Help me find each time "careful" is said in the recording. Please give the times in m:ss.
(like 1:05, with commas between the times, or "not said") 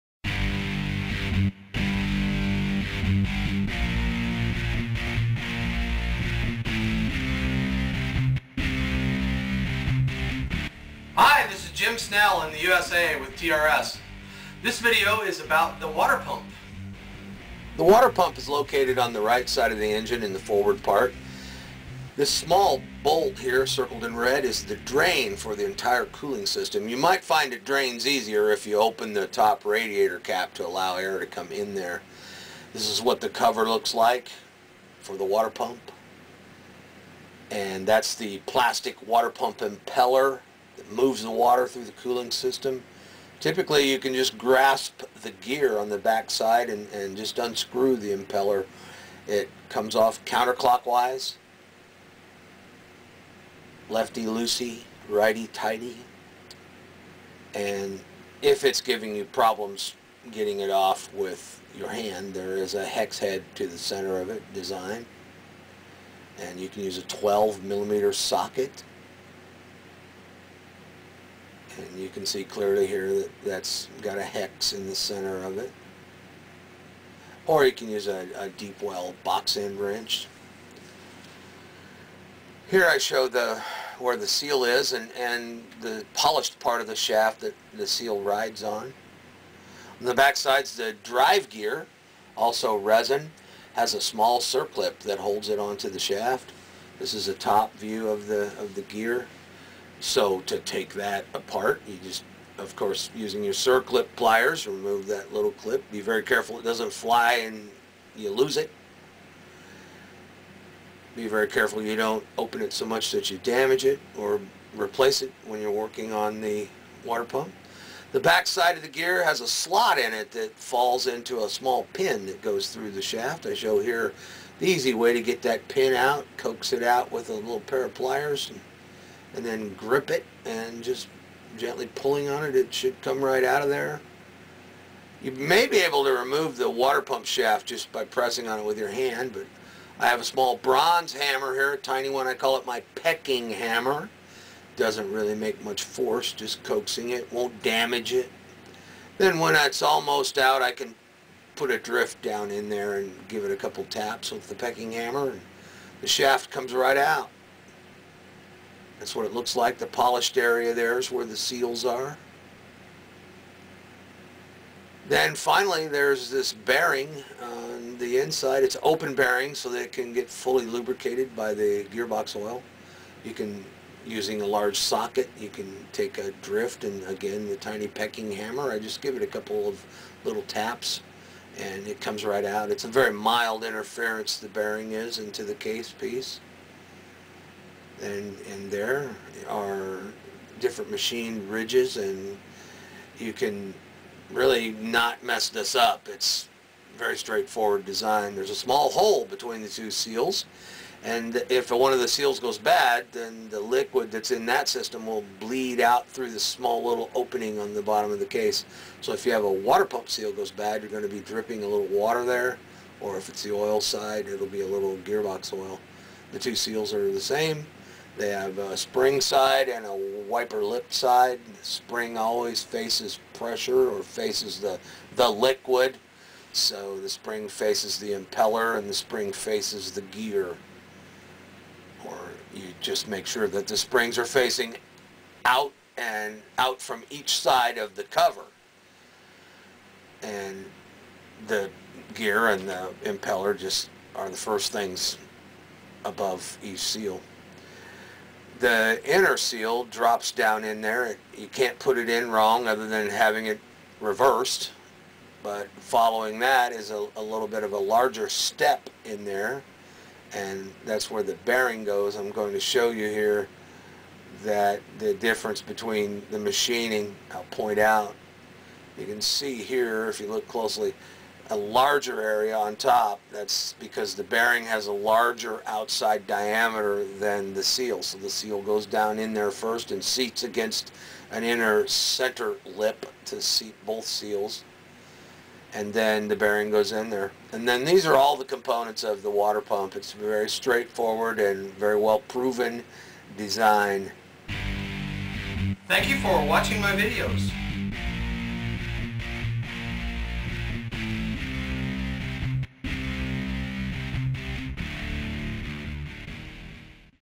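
1:46, 1:51.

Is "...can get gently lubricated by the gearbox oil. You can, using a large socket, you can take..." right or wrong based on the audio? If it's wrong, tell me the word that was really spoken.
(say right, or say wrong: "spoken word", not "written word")
wrong: "fully", not "gently".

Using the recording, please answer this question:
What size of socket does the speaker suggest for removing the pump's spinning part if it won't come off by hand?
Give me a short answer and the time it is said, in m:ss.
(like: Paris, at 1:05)
12 millimeter, at 1:07.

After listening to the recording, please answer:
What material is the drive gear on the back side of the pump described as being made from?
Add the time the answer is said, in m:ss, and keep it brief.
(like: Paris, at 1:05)
resin, at 1:32.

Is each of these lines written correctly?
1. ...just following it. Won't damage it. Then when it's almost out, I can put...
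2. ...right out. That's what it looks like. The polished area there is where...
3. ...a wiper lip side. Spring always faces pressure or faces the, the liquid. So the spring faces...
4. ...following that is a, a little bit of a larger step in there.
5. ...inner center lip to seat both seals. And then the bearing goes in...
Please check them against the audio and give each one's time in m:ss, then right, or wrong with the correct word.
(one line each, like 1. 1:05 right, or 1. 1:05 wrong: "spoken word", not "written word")
1. 2:26 wrong: "coaxing", not "following"
2. 2:36 right
3. 3:39 right
4. 4:15 right
5. 4:41 right.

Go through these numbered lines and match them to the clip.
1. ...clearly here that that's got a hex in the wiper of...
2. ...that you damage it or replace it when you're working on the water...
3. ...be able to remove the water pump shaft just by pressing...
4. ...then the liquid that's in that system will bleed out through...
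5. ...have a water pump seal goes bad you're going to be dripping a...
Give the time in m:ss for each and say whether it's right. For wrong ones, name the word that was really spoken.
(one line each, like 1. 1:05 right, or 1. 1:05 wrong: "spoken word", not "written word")
1. 1:12 wrong: "center", not "wiper"
2. 1:53 right
3. 2:15 right
4. 3:23 right
5. 3:29 right.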